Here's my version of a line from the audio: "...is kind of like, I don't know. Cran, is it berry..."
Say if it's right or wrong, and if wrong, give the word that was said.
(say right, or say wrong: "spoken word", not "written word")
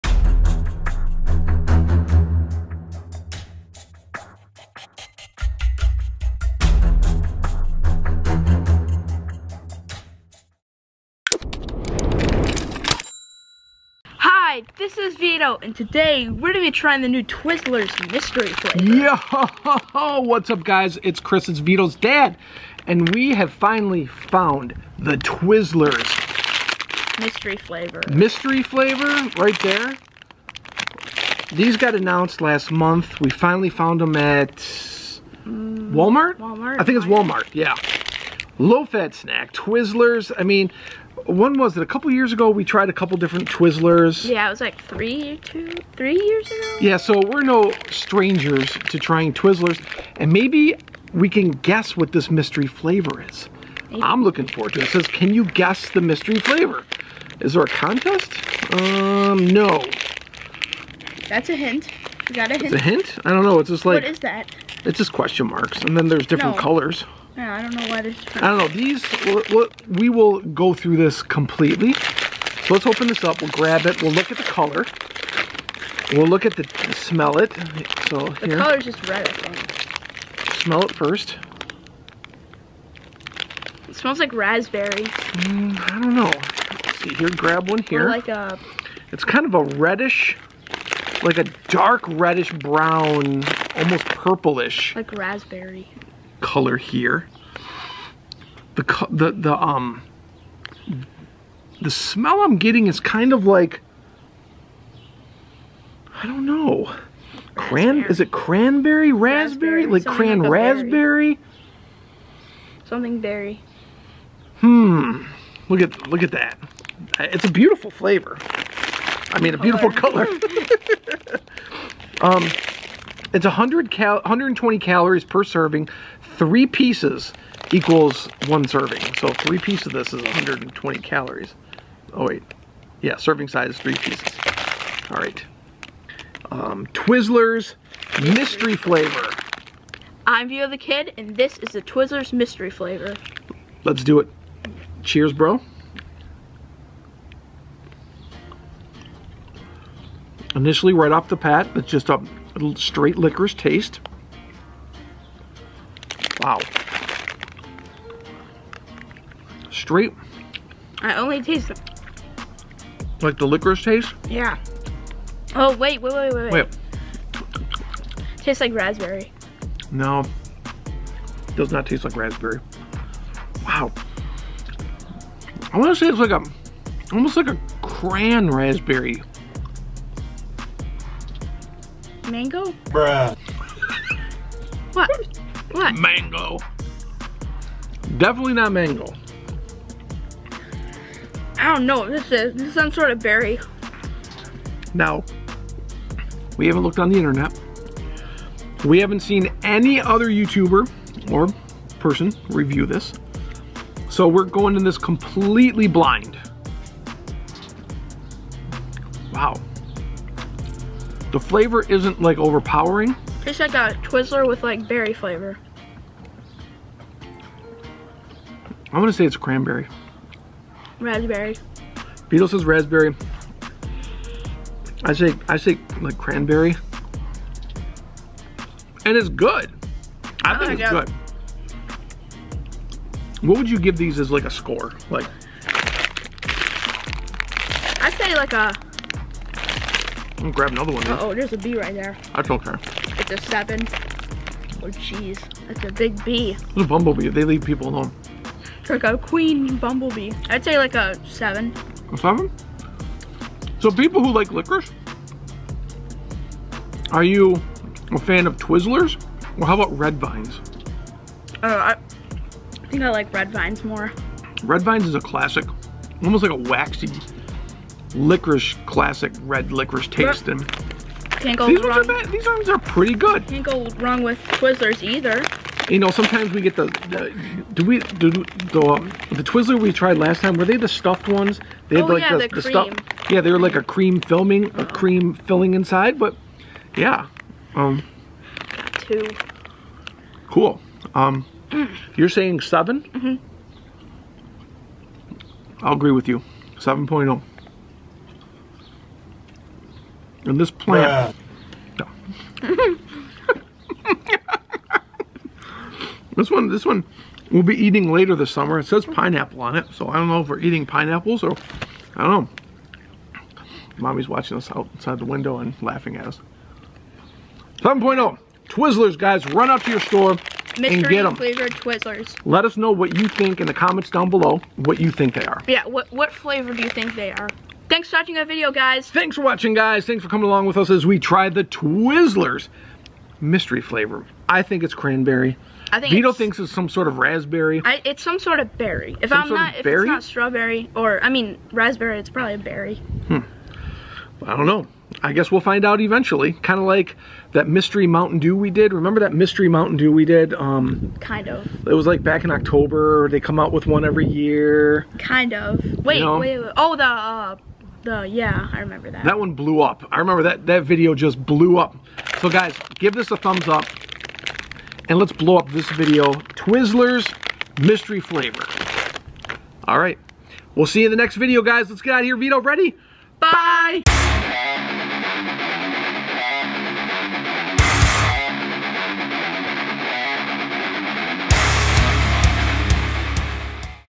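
wrong: "cranberry", not "berry".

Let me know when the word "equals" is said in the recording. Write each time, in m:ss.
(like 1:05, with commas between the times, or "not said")
2:07.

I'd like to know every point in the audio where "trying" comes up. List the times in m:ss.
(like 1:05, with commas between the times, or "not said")
0:16, 0:48.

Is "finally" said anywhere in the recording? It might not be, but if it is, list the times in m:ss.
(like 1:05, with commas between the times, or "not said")
0:23, 0:33.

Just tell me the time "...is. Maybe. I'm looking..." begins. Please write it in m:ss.
0:53.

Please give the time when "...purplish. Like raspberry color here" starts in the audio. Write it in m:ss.
1:34.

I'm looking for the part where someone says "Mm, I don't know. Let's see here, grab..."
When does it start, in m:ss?
1:25.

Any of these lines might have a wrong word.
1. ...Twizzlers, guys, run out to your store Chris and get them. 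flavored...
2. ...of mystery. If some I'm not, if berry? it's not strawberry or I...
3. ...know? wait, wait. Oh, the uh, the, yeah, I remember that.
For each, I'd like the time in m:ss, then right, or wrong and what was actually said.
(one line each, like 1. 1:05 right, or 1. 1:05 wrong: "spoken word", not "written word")
1. 5:18 wrong: "Mystery", not "Chris"
2. 5:38 wrong: "berry", not "mystery"
3. 5:56 right.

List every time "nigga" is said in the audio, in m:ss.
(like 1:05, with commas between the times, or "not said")
not said.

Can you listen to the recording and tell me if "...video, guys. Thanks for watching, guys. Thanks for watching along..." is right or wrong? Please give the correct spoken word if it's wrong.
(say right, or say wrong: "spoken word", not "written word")
wrong: "coming", not "watching".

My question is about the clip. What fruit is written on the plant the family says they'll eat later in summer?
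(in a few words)
Pineapple.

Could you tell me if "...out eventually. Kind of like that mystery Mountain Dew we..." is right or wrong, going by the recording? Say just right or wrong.
right.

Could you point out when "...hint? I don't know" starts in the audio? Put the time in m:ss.
1:02.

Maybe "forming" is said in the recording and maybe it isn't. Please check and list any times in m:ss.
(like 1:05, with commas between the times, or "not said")
not said.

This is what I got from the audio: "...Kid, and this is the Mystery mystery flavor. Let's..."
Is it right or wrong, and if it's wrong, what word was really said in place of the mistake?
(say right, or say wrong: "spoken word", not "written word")
wrong: "Twizzlers", not "Mystery".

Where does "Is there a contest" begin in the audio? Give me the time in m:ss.
0:57.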